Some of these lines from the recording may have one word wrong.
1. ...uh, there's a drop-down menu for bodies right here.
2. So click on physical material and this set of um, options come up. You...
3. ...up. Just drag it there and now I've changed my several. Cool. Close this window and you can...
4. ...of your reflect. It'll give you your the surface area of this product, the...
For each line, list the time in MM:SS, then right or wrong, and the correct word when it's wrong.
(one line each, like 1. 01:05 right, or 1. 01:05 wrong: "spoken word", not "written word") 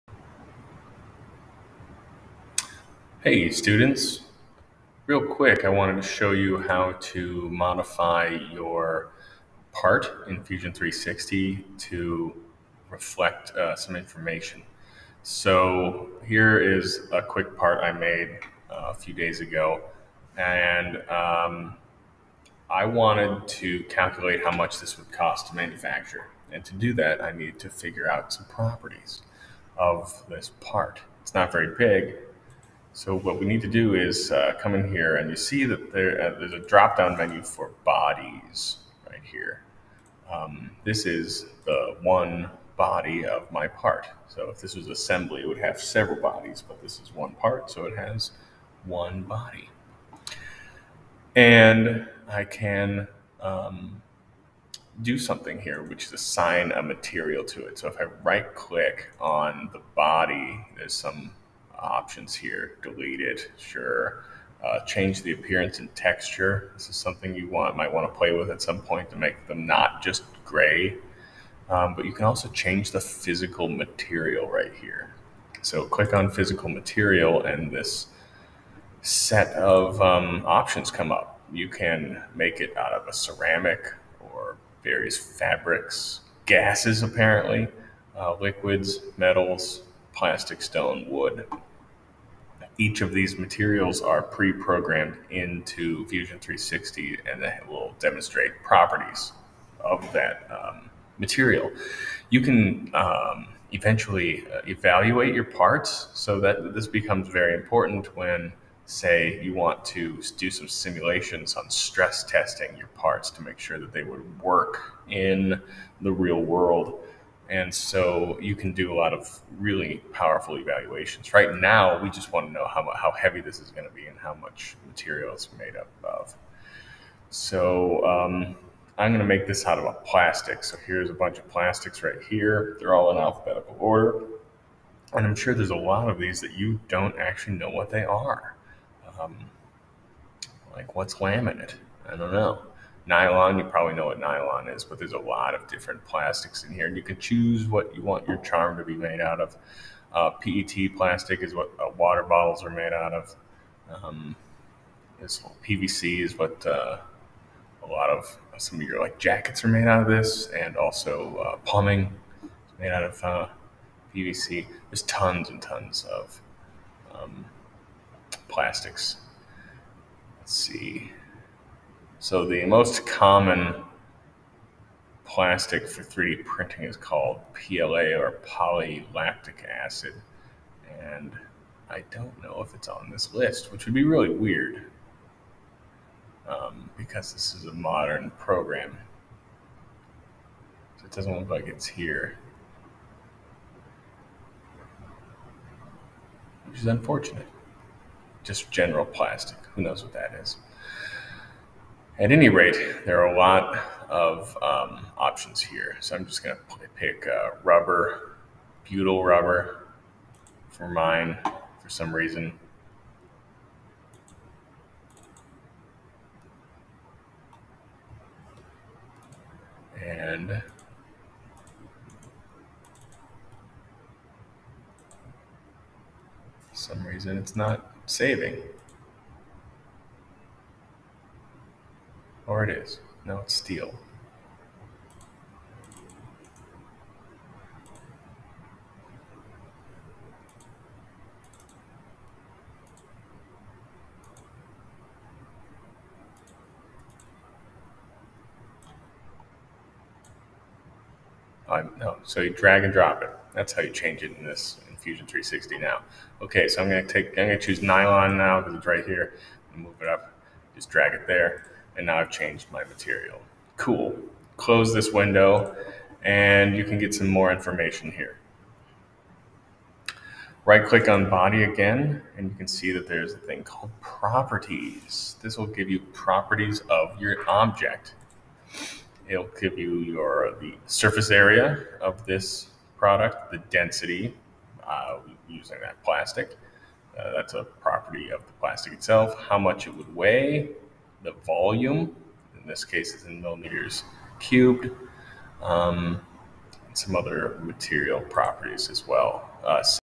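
1. 00:36 right
2. 01:15 right
3. 04:20 wrong: "material", not "several"
4. 04:36 wrong: "object", not "reflect".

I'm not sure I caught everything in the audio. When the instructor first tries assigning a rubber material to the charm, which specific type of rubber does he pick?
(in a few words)
Butyl rubber.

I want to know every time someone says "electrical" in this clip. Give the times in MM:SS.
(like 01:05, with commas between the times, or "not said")
not said.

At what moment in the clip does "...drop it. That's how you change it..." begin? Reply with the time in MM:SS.
04:12.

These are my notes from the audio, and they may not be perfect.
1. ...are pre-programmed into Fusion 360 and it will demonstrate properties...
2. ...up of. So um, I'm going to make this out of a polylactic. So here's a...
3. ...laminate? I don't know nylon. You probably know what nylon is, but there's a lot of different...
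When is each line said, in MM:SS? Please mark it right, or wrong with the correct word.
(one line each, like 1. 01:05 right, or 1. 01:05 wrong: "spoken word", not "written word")
1. 01:34 right
2. 02:05 wrong: "plastic", not "polylactic"
3. 02:21 right.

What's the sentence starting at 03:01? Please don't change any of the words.
And I don't know if it's on this list, which would be really weird um, because this is a modern program.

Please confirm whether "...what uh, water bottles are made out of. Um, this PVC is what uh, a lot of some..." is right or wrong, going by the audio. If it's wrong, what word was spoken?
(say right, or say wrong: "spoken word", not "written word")
right.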